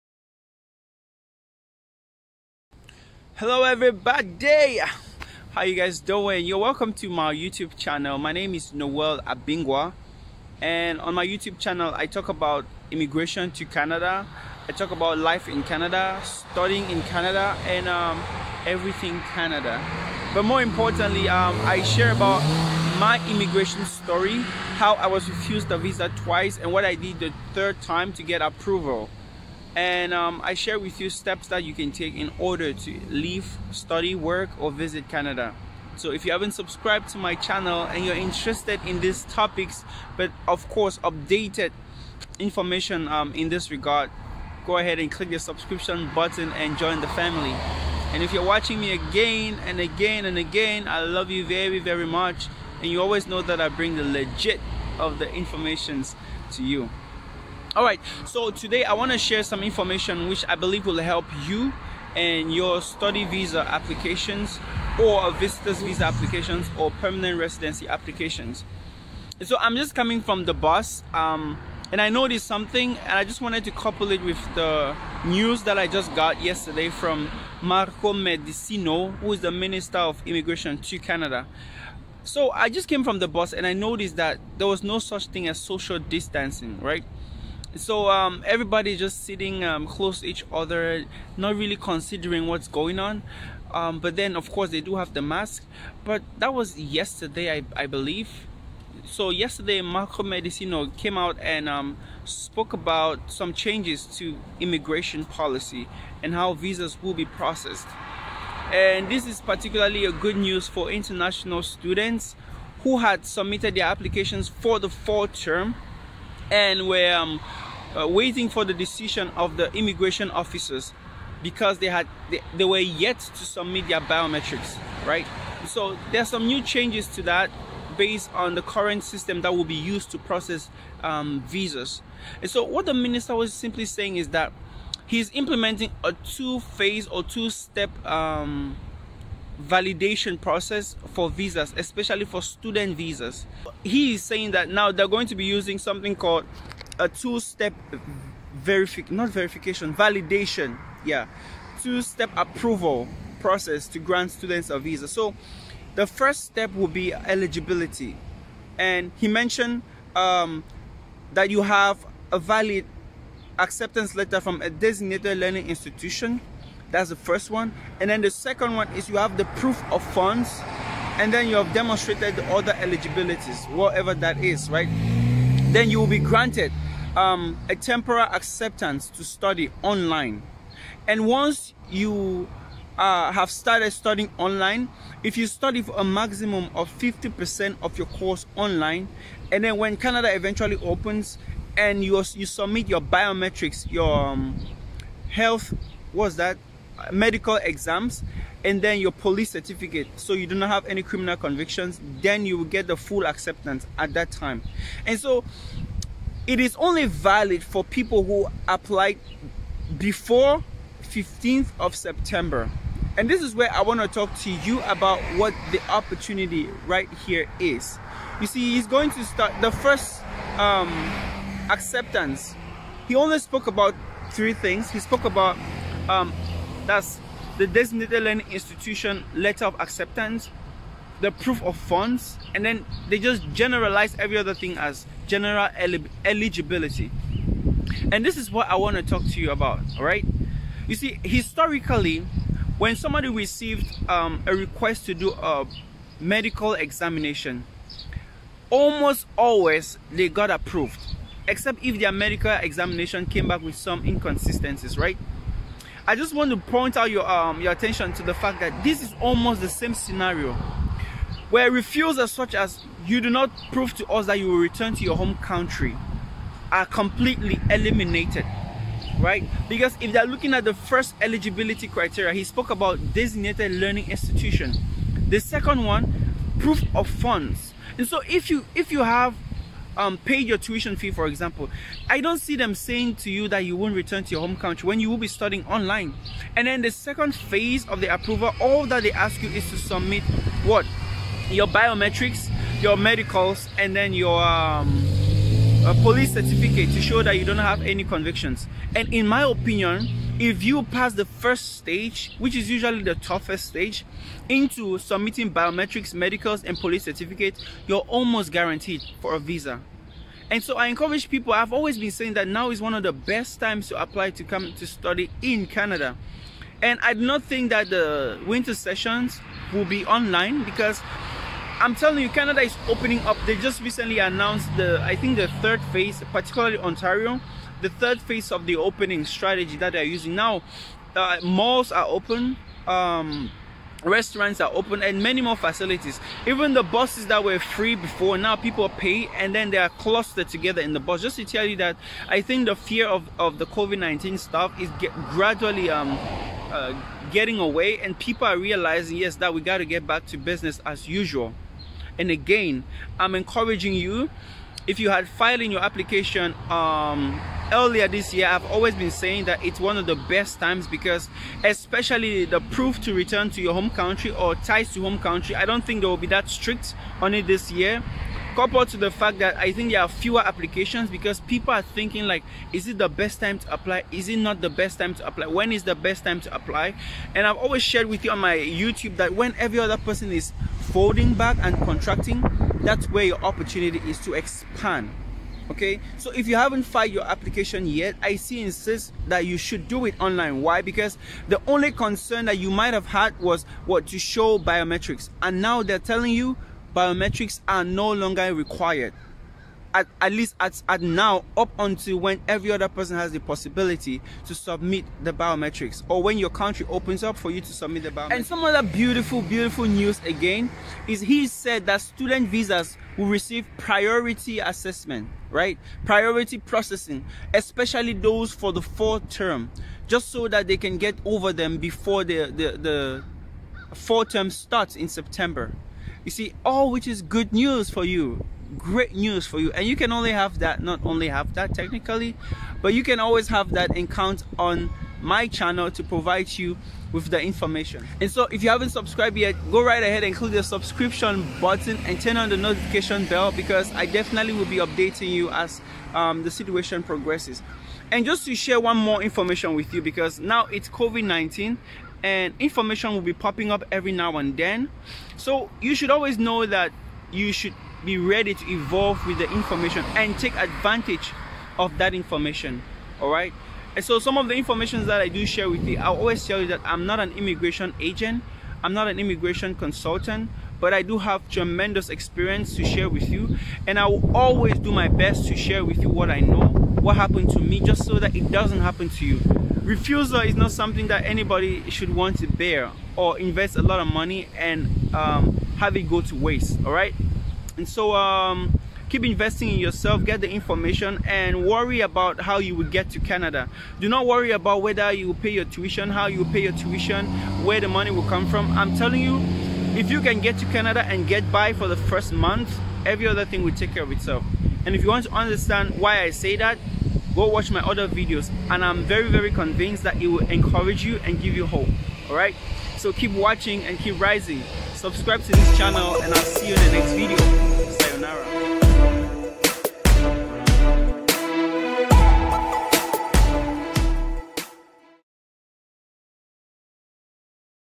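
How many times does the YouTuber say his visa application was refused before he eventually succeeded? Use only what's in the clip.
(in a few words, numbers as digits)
twice.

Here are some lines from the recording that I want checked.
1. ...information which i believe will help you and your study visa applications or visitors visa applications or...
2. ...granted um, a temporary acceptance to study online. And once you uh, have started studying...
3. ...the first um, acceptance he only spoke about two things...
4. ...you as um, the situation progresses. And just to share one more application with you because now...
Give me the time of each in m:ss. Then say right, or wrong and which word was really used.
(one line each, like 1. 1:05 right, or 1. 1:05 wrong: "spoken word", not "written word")
1. 0:59 right
2. 2:56 right
3. 3:39 wrong: "three", not "two"
4. 7:25 wrong: "information", not "application".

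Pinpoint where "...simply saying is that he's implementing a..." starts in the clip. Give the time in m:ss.
2:13.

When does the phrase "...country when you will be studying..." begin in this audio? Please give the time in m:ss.
4:44.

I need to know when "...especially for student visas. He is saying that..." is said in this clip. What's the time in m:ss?
2:21.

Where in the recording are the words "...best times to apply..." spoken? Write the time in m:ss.
5:13.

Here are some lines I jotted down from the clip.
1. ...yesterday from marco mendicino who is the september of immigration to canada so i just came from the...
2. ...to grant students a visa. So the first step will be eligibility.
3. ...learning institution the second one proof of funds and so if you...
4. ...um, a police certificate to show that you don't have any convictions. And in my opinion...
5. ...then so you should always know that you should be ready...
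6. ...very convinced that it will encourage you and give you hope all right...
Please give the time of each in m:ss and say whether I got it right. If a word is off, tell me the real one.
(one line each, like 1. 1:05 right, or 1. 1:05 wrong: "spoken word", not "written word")
1. 1:16 wrong: "minister", not "september"
2. 2:33 right
3. 4:33 right
4. 4:54 right
5. 7:34 right
6. 8:29 right.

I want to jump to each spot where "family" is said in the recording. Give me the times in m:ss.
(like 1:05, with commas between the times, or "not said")
0:47.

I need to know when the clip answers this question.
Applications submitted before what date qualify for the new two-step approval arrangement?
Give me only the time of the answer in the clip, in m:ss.
3:31.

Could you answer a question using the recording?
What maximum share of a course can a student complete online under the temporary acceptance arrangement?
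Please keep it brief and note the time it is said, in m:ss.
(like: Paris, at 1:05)
50%, at 3:06.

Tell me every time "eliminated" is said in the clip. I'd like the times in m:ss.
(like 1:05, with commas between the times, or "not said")
4:27.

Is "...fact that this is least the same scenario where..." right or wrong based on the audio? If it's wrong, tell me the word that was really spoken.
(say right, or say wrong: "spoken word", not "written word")
wrong: "almost", not "least".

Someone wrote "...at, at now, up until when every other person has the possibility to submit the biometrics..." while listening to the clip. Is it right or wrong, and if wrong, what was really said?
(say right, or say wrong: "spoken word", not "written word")
right.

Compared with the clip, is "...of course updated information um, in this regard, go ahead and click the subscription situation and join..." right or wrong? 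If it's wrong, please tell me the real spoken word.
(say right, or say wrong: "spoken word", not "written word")
wrong: "button", not "situation".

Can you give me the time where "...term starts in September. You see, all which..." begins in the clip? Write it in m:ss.
7:04.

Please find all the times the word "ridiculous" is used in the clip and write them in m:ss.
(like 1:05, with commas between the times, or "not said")
not said.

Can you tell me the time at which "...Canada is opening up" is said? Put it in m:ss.
5:22.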